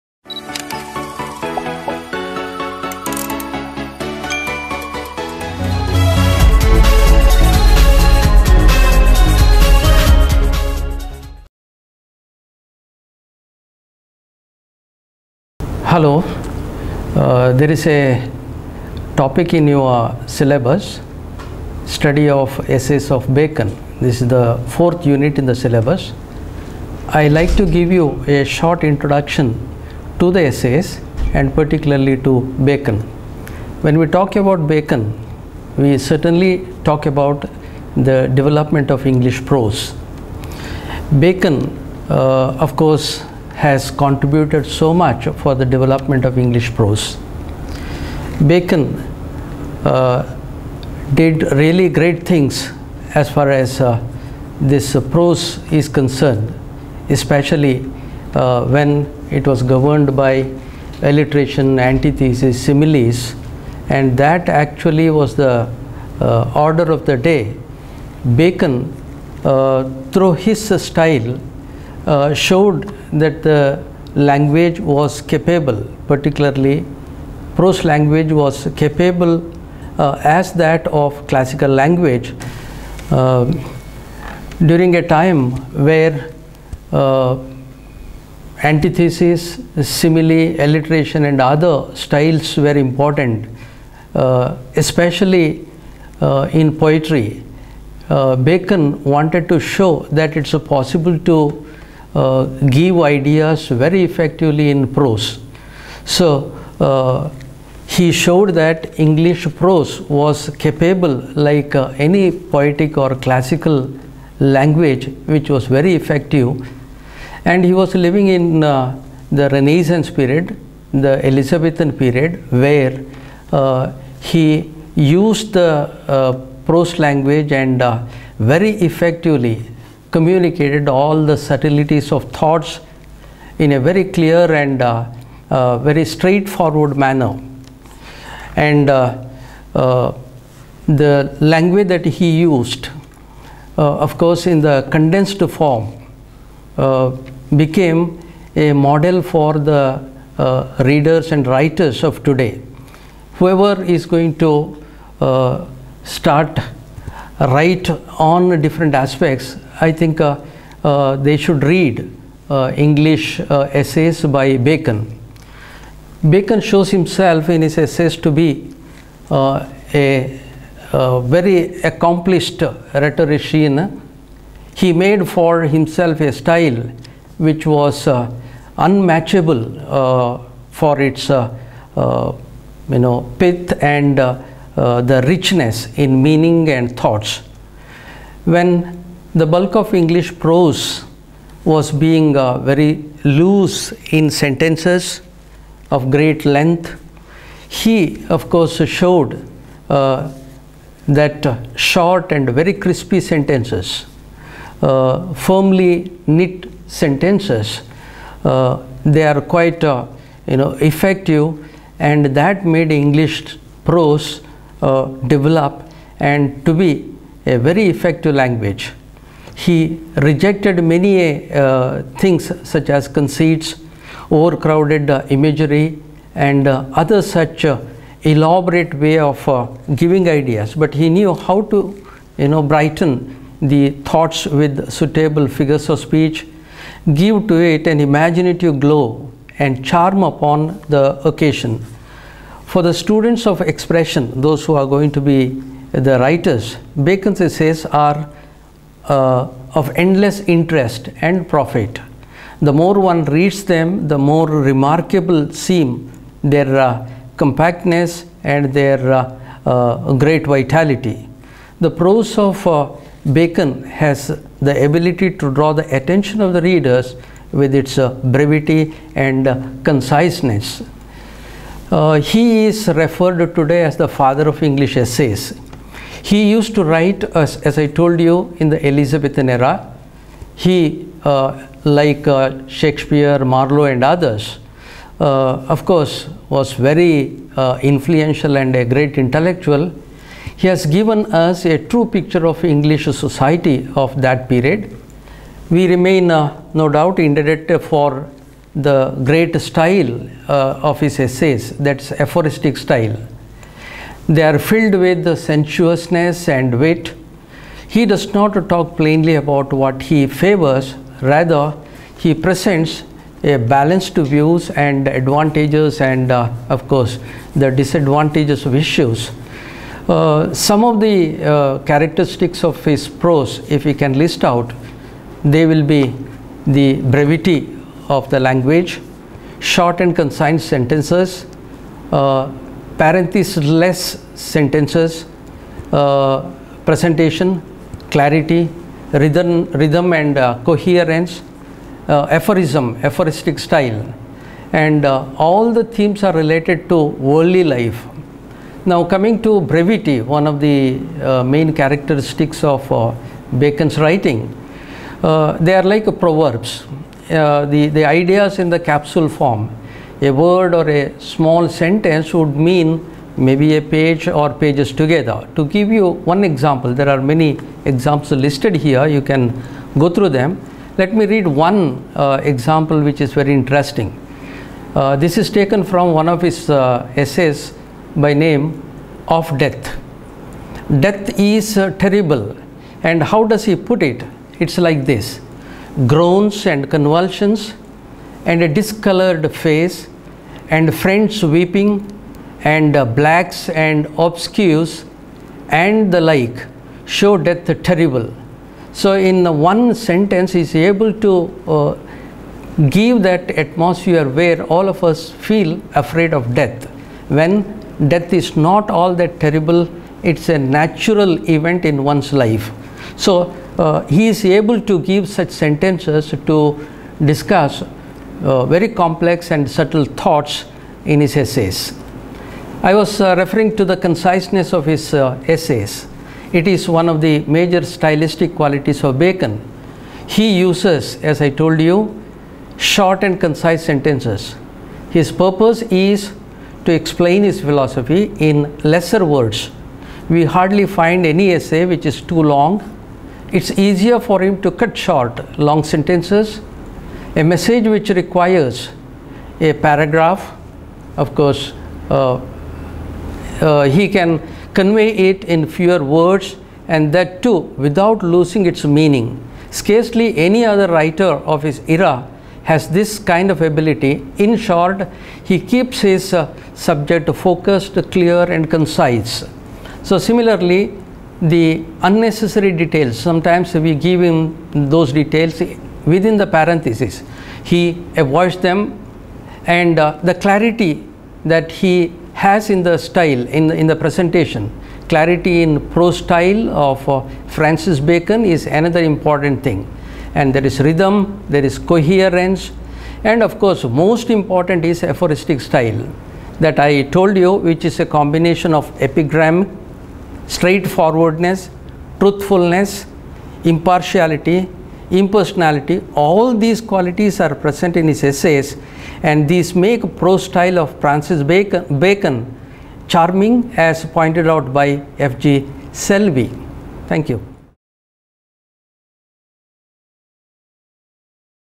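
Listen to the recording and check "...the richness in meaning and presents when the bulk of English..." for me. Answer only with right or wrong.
wrong.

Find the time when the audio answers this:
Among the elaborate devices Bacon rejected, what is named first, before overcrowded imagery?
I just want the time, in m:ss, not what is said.
3:43.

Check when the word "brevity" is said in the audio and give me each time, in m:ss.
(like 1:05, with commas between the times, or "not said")
4:28, 5:27, 5:49.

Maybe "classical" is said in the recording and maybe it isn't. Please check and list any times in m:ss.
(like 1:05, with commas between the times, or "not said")
1:21, 1:53.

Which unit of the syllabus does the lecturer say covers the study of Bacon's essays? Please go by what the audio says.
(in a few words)
fourth.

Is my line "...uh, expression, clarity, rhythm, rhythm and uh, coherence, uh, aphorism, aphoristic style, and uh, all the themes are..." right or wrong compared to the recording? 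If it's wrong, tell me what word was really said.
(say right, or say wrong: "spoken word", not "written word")
wrong: "presentation", not "expression".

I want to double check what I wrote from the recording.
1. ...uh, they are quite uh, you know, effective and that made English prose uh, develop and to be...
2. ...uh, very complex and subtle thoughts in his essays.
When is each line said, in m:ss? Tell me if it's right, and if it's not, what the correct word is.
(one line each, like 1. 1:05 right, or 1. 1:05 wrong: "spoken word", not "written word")
1. 3:28 right
2. 6:58 right.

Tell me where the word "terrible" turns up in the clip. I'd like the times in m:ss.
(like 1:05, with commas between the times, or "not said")
6:21, 6:37, 6:49.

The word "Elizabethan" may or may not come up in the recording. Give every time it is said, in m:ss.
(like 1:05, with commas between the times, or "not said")
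2:01, 4:38.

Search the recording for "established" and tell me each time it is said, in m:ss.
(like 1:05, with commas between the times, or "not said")
not said.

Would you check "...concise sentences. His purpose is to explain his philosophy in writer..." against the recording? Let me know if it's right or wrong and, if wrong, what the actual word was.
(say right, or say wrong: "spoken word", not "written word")
wrong: "lesser", not "writer".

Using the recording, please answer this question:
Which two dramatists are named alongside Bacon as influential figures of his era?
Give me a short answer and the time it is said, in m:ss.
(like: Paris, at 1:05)
Shakespeare, Marlowe, at 4:42.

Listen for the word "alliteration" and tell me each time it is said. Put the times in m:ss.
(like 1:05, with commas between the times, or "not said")
1:01, 1:30.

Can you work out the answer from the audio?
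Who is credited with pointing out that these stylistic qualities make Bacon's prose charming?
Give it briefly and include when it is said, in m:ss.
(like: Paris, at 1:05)
F.G. Selby, at 8:35.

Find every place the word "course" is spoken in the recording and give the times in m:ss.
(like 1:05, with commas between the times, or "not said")
0:42, 2:24, 3:18, 4:45, 5:16, 7:31, 8:13.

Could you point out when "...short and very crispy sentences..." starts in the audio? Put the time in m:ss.
3:21.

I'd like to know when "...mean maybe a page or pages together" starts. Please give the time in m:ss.
6:02.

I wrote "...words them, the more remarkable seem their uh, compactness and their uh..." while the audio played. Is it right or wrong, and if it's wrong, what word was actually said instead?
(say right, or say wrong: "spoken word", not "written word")
wrong: "reads", not "words".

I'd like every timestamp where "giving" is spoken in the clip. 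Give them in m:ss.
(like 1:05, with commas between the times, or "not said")
3:49.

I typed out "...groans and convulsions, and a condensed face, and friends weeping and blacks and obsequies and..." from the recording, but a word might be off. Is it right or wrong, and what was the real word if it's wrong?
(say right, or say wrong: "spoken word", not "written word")
wrong: "discolored", not "condensed".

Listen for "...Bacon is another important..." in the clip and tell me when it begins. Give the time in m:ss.
8:07.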